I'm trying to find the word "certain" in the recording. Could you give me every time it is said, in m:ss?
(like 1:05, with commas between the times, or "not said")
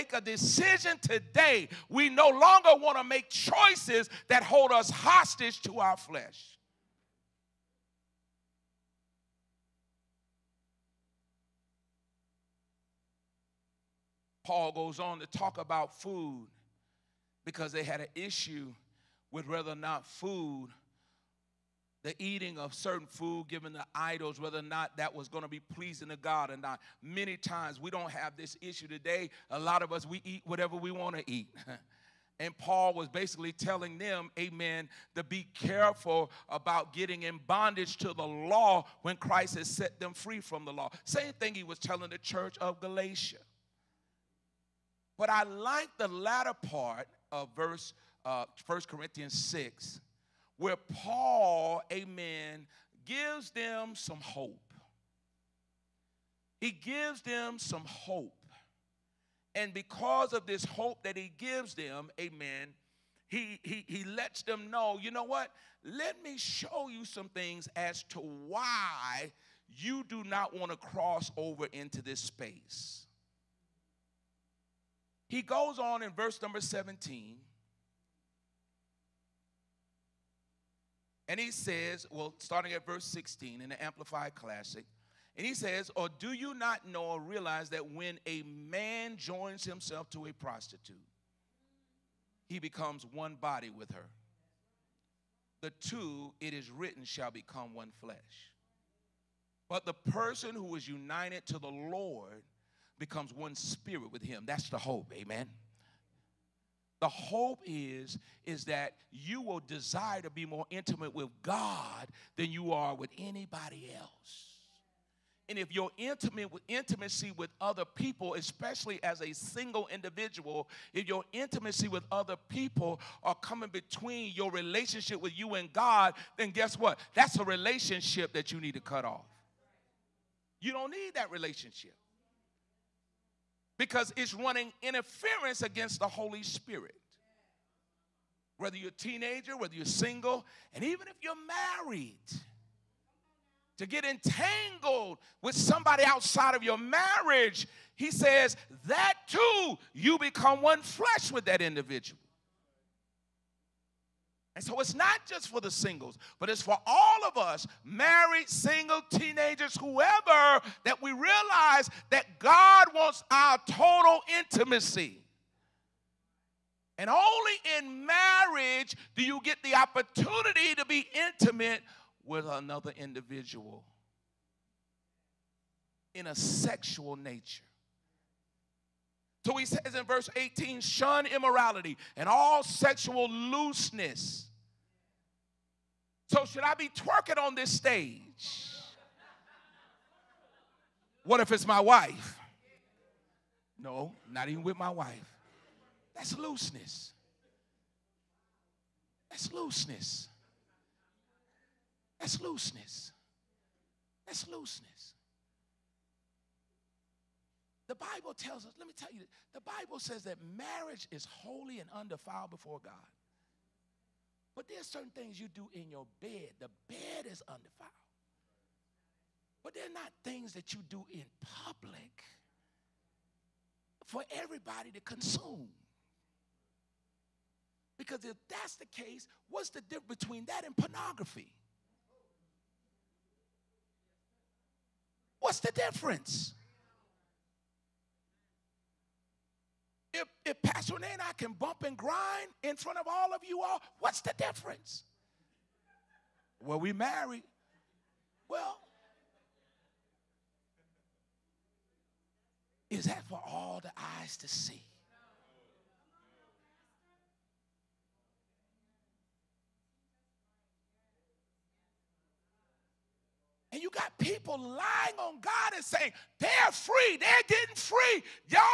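0:22, 3:34.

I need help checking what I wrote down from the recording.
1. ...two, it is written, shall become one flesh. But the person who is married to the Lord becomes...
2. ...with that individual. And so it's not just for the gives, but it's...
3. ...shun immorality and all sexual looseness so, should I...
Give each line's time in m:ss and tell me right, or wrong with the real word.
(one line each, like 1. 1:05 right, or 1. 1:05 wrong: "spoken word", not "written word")
1. 1:35 wrong: "united", not "married"
2. 2:31 wrong: "singles", not "gives"
3. 3:00 right.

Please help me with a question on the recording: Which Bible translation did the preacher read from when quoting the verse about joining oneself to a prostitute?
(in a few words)
Amplified Classic.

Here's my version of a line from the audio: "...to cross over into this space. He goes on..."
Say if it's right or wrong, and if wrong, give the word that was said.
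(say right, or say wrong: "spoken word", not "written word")
right.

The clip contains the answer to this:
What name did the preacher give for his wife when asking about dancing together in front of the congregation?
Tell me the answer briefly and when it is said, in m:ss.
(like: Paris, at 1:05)
Pastor Renee, at 4:00.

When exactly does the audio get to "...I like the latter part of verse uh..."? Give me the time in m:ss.
0:45.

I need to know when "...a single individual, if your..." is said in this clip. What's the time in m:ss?
1:59.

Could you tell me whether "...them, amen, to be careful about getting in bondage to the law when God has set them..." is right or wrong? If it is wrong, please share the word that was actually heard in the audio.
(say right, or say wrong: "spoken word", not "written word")
wrong: "Christ", not "God".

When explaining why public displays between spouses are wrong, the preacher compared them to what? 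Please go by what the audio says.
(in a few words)
Pornography.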